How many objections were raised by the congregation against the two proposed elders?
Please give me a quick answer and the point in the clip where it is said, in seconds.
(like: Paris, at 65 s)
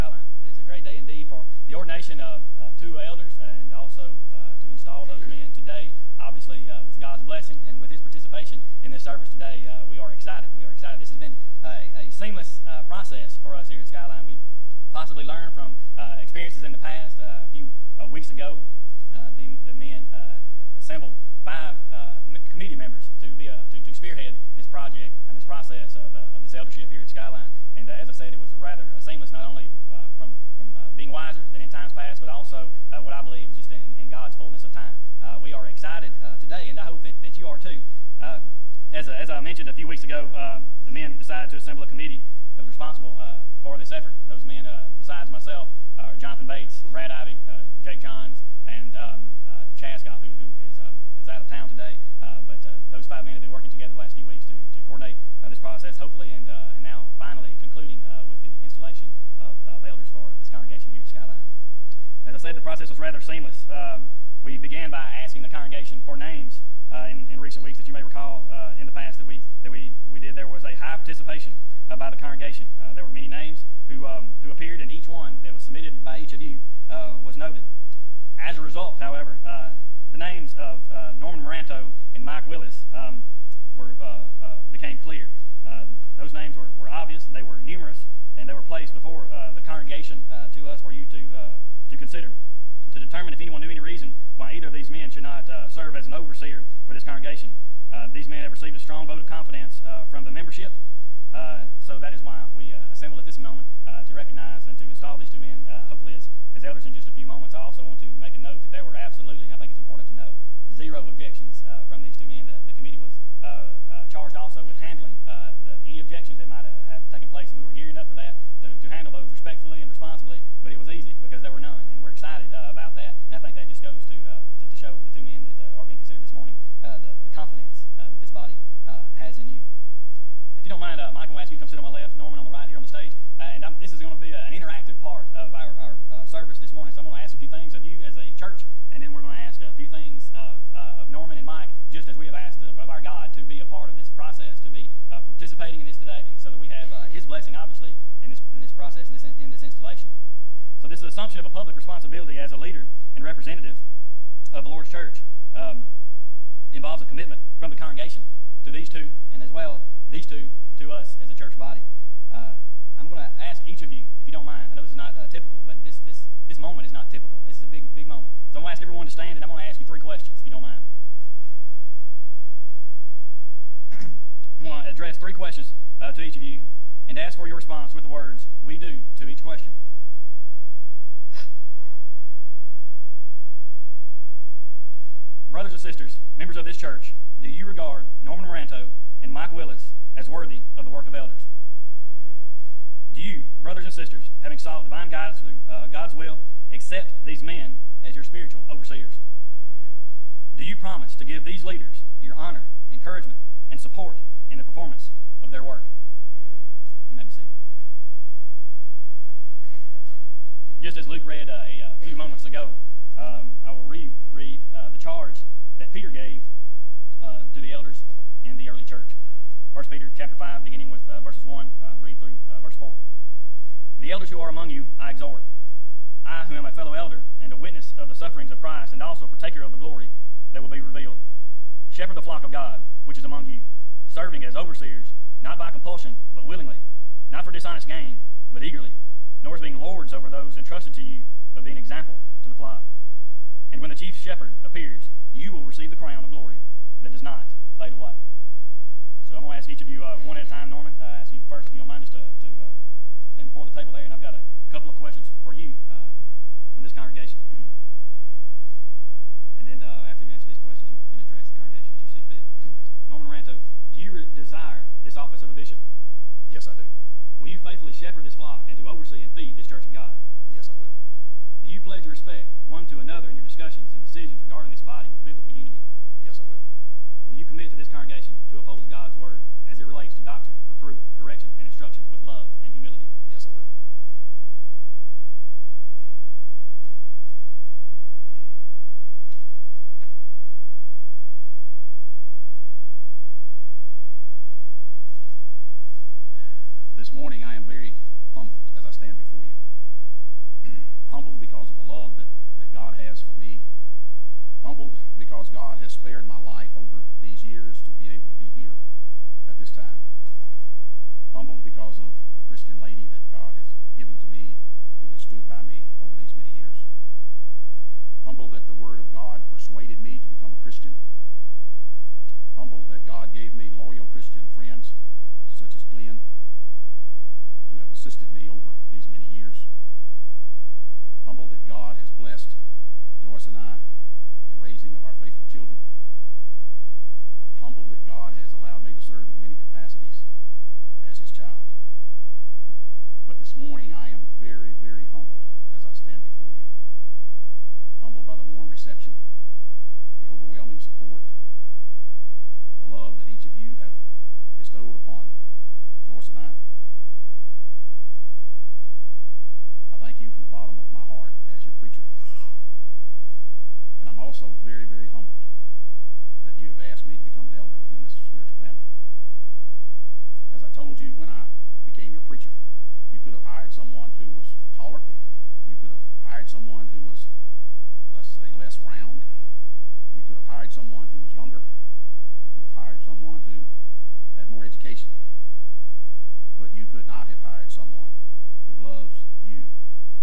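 0, at 110 s.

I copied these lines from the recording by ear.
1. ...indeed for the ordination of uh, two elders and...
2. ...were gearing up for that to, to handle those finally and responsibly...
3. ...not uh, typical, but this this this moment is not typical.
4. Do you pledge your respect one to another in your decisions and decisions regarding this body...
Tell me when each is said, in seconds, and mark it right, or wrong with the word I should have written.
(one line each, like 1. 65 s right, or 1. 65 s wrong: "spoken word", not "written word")
1. 0 s right
2. 117 s wrong: "respectfully", not "finally"
3. 164 s right
4. 271 s wrong: "discussions", not "decisions".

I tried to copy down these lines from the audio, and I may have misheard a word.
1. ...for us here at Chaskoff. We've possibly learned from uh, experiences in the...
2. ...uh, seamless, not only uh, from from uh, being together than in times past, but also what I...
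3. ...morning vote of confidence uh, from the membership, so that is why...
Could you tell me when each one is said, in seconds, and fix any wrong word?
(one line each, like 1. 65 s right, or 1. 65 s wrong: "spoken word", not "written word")
1. 13 s wrong: "Skyline", not "Chaskoff"
2. 28 s wrong: "wiser", not "together"
3. 98 s wrong: "strong", not "morning".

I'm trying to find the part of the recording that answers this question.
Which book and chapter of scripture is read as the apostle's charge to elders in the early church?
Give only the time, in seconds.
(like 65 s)
219 s.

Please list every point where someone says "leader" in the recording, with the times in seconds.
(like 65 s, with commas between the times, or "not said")
152 s, 201 s.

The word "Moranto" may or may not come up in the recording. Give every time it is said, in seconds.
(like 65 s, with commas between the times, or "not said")
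81 s, 188 s.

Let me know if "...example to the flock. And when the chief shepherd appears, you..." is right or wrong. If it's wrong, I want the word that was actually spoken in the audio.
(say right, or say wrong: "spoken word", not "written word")
right.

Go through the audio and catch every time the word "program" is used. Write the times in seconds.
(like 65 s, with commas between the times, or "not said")
not said.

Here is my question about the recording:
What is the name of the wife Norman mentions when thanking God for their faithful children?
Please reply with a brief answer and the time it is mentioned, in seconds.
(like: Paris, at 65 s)
Joyce, at 333 s.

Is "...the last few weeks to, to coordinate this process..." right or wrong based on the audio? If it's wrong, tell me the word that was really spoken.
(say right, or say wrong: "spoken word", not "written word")
right.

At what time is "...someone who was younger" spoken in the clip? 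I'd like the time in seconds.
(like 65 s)
380 s.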